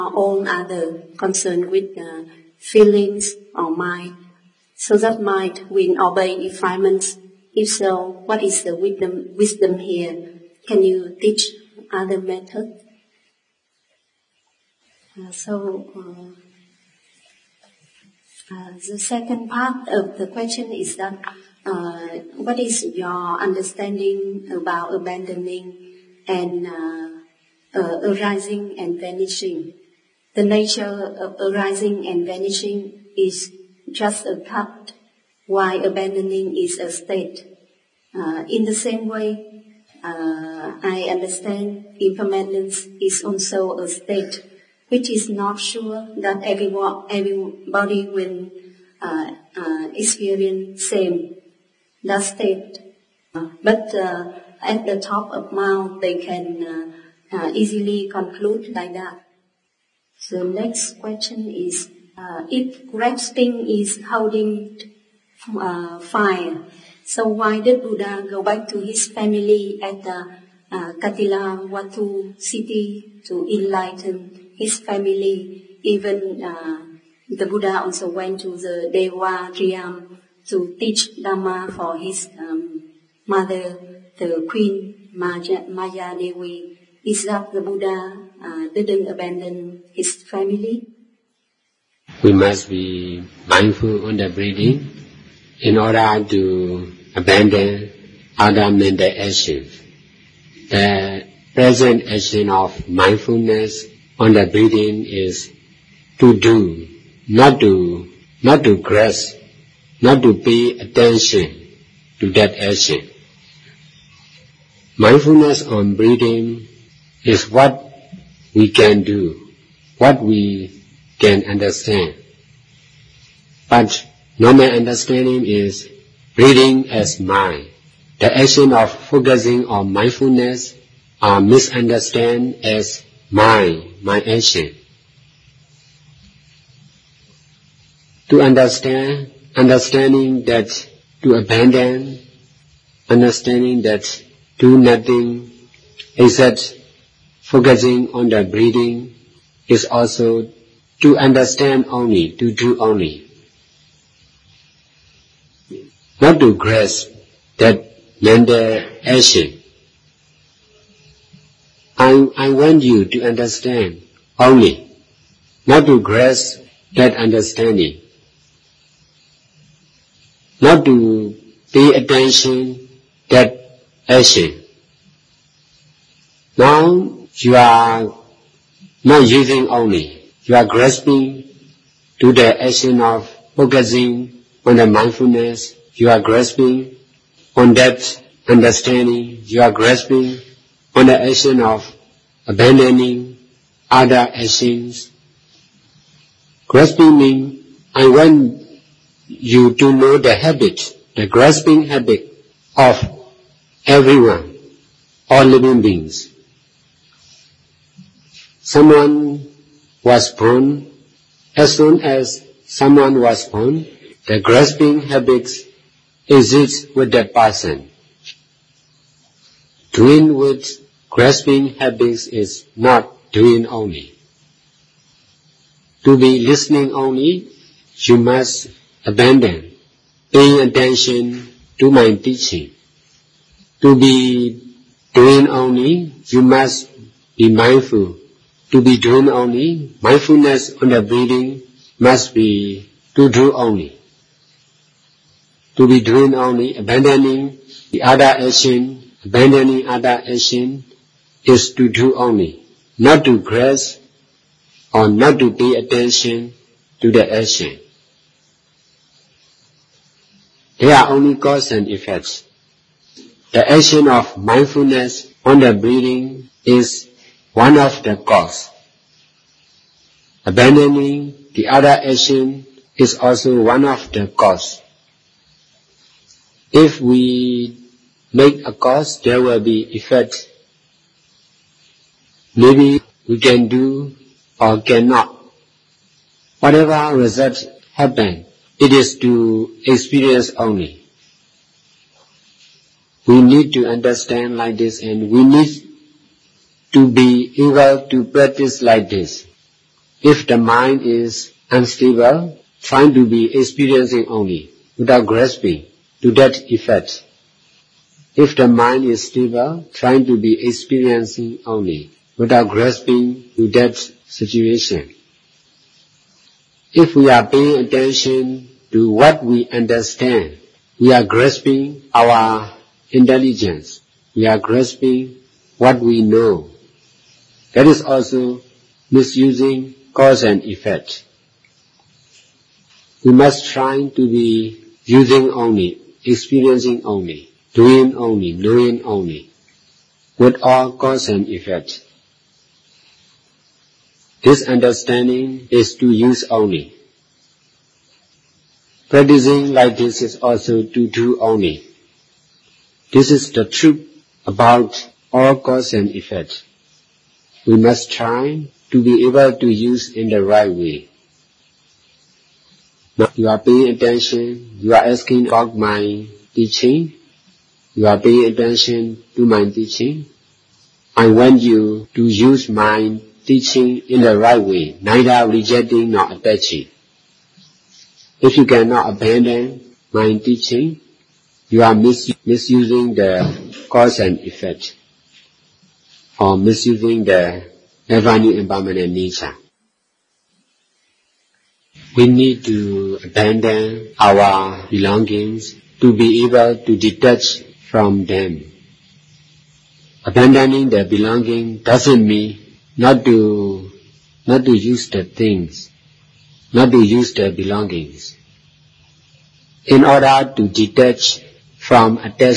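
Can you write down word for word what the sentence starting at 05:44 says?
This understanding is to use only.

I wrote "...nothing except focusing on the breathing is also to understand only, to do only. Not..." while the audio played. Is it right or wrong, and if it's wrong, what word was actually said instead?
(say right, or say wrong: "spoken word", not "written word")
right.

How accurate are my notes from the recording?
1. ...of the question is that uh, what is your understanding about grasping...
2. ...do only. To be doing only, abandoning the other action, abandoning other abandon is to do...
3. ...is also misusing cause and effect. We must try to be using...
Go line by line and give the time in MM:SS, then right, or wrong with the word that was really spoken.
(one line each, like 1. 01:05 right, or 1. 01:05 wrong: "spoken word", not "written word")
1. 00:19 wrong: "abandoning", not "grasping"
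2. 04:03 wrong: "action", not "abandon"
3. 05:27 right.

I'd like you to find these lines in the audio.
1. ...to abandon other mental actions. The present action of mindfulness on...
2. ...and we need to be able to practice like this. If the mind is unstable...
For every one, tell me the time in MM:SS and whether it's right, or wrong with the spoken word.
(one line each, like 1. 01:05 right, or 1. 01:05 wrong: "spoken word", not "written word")
1. 01:36 right
2. 04:55 right.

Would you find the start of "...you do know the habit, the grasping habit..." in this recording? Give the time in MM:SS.
03:19.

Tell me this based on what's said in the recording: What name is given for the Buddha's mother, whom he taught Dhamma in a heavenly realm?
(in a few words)
Queen Maya.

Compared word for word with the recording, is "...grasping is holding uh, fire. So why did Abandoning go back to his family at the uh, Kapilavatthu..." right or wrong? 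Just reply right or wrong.
wrong.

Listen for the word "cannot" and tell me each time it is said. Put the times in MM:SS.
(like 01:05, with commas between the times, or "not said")
04:44, 06:18.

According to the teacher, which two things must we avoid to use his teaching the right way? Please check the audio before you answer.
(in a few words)
rejecting nor attaching.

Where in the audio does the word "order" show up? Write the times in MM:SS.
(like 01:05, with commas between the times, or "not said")
01:35, 06:50.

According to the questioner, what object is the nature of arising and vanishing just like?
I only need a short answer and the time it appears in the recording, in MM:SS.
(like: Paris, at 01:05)
a cup, at 00:33.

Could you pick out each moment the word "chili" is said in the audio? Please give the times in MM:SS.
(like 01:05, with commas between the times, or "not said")
not said.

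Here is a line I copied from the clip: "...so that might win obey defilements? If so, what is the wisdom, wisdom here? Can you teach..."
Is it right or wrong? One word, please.
right.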